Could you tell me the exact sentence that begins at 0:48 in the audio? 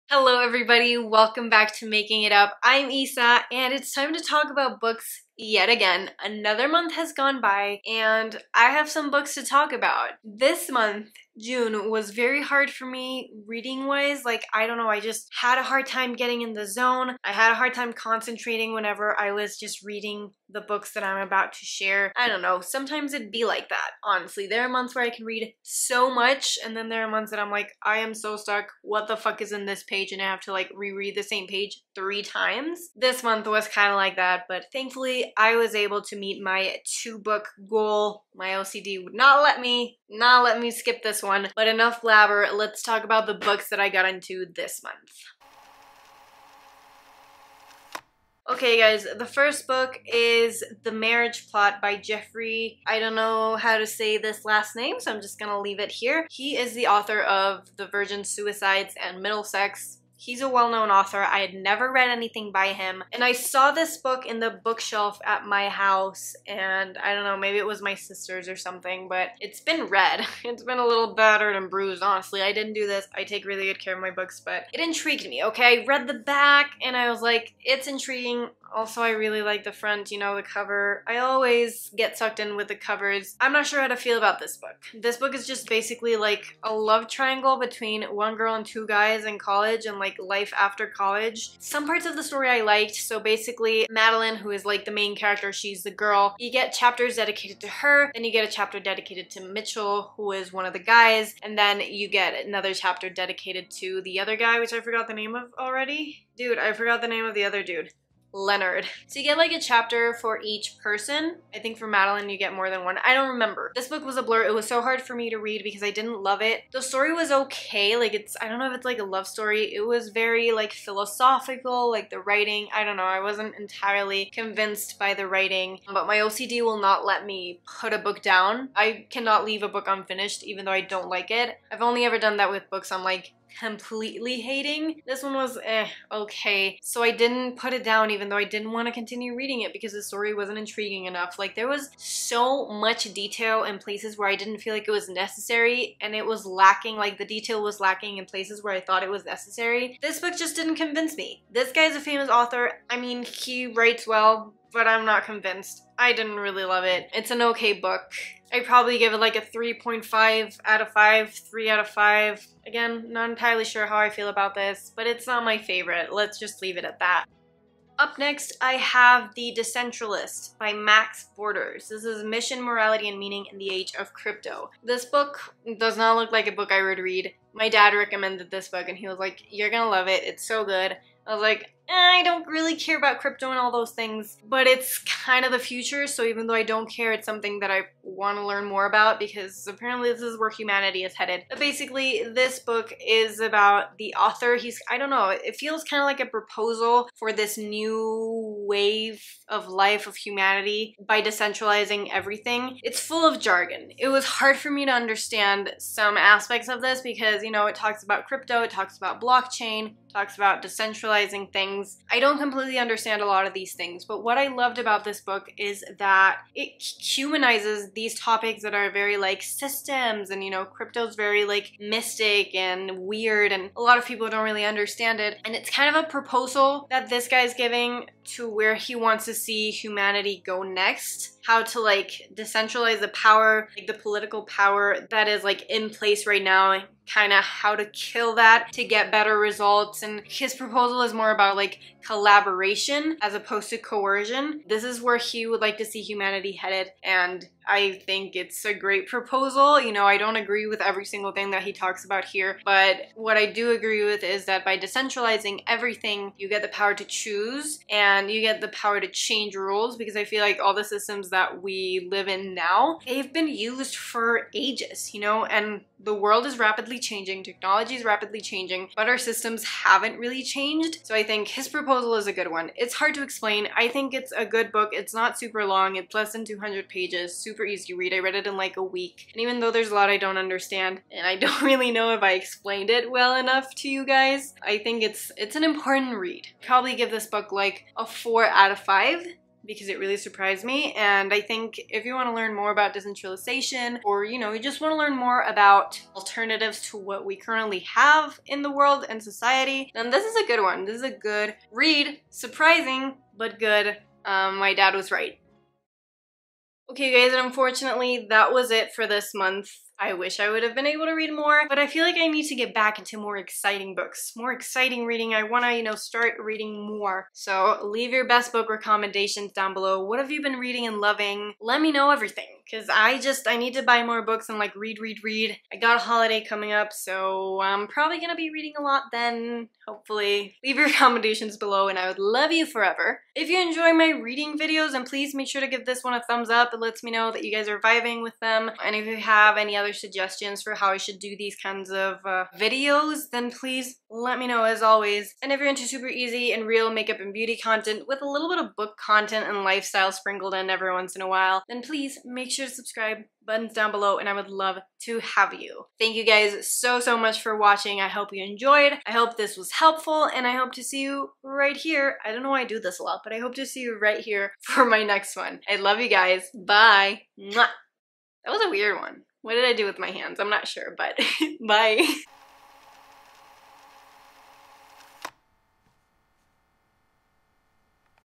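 Okay guys, the first book is The Marriage Plot by Jeffrey.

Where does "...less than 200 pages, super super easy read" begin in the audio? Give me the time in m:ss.
4:36.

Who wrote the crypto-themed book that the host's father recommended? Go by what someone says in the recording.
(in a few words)
Max Borders.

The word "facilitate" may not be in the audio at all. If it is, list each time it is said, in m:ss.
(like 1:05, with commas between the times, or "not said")
not said.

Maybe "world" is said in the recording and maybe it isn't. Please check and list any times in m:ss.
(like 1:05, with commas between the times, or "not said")
4:26, 4:58.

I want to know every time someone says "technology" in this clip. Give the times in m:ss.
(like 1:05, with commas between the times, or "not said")
4:27.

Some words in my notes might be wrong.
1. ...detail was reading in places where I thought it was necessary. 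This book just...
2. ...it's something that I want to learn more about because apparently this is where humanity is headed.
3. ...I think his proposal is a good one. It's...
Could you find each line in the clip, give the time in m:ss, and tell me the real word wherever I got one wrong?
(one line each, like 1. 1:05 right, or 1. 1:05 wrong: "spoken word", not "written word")
1. 2:27 wrong: "lacking", not "reading"
2. 3:07 right
3. 4:31 right.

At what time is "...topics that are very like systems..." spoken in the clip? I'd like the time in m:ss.
3:38.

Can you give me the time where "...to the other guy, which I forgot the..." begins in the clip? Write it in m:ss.
1:43.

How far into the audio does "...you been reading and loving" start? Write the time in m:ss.
5:20.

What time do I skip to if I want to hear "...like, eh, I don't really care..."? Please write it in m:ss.
3:01.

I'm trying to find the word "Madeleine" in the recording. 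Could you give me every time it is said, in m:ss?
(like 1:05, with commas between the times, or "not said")
1:33, 1:51.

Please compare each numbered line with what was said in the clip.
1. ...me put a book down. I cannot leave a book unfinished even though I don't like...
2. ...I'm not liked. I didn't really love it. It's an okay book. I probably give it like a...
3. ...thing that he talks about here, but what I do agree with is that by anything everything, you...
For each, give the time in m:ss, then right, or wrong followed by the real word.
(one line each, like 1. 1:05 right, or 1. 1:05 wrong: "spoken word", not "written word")
1. 2:07 right
2. 2:34 wrong: "convinced", not "liked"
3. 4:11 wrong: "decentralizing", not "anything".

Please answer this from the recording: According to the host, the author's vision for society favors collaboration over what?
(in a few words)
coercion.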